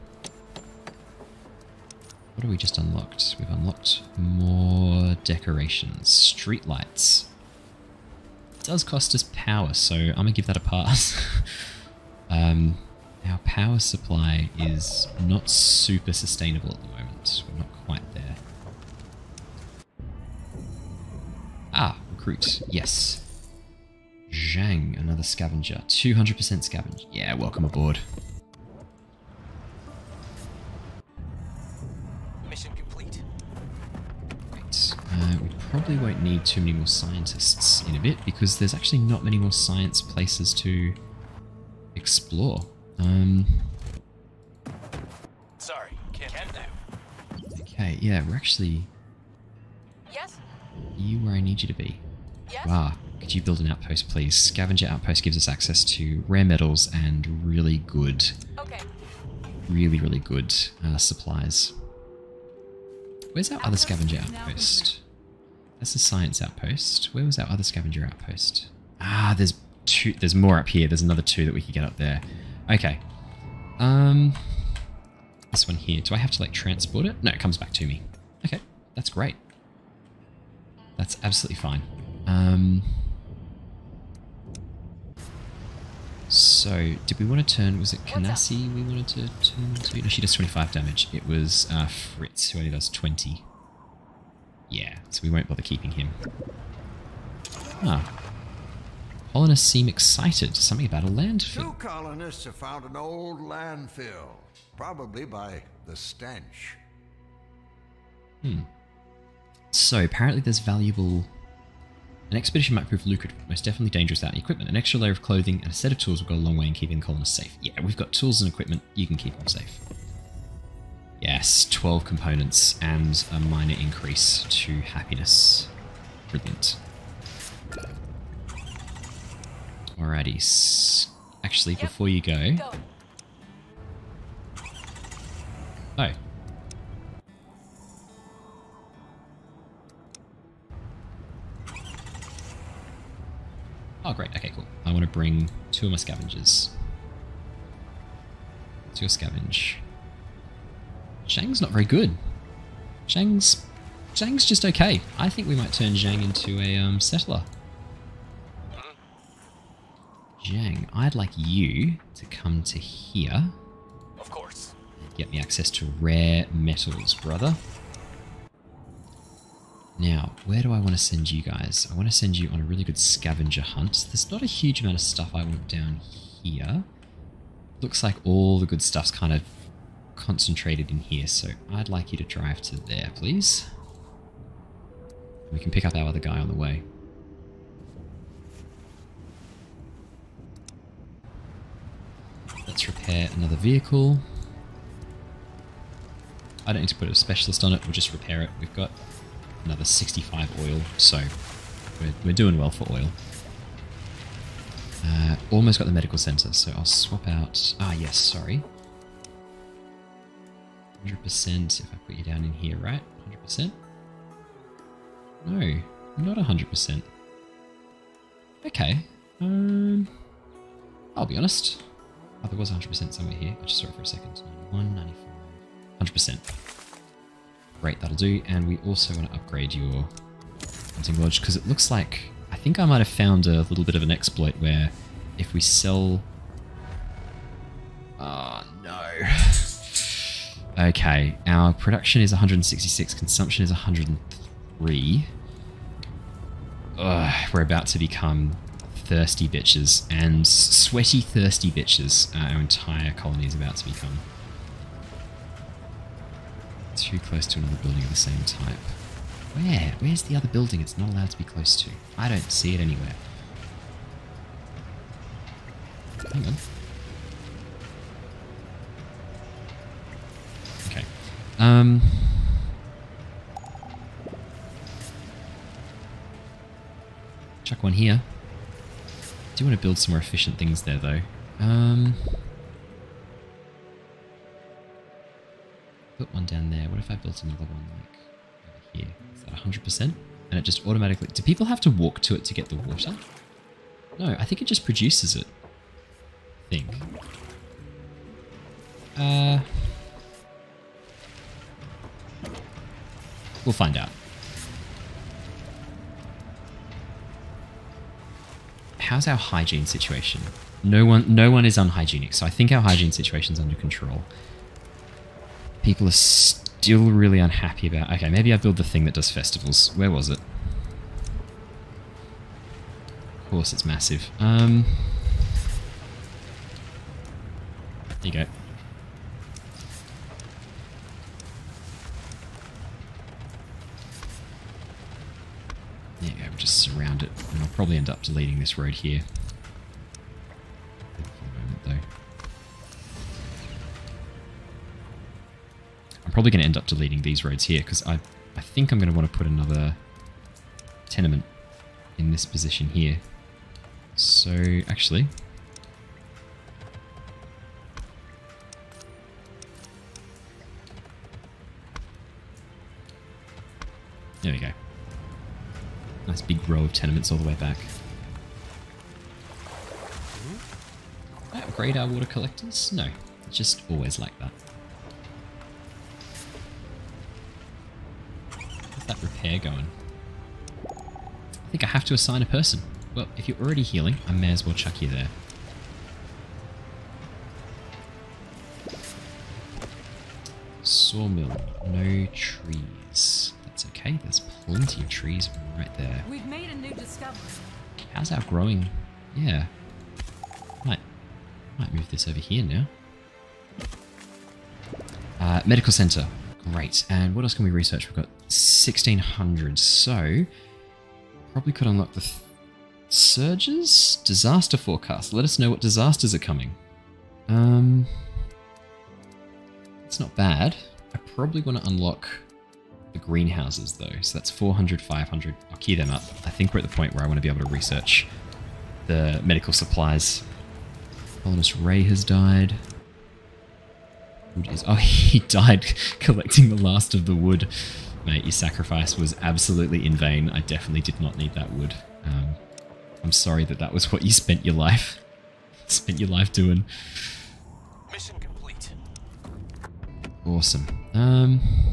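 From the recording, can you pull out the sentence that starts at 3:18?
We've got another 65 oil, so we're, we're doing well for oil.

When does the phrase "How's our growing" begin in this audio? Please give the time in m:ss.
6:38.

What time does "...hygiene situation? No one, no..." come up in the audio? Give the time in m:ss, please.
5:09.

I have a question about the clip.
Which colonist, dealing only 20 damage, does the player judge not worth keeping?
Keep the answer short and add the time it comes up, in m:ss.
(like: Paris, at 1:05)
Fritz, at 1:31.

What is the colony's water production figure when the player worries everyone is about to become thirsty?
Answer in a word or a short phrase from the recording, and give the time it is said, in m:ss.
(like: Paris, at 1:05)
166, at 4:02.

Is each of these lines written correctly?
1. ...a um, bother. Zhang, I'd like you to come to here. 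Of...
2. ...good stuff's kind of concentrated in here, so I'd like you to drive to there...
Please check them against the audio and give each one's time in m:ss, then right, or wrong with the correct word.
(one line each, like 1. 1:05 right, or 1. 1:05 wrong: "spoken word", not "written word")
1. 2:36 wrong: "settler", not "bother"
2. 2:58 right.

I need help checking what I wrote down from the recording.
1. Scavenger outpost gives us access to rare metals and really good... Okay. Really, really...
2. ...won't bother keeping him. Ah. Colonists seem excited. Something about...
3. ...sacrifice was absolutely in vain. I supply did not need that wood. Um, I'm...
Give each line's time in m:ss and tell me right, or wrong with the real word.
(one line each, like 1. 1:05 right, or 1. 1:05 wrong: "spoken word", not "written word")
1. 0:54 right
2. 1:35 right
3. 7:18 wrong: "definitely", not "supply".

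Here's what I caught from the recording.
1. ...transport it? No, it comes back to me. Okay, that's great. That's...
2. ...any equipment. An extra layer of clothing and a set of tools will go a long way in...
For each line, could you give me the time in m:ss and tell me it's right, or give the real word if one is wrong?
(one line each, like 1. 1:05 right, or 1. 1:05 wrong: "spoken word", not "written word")
1. 1:16 right
2. 1:54 right.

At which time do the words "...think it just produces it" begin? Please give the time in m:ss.
4:54.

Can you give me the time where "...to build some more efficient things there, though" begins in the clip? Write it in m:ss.
4:39.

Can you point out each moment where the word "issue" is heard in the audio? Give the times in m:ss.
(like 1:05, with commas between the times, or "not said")
not said.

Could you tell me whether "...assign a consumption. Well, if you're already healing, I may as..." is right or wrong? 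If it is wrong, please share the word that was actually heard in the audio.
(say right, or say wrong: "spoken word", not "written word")
wrong: "person", not "consumption".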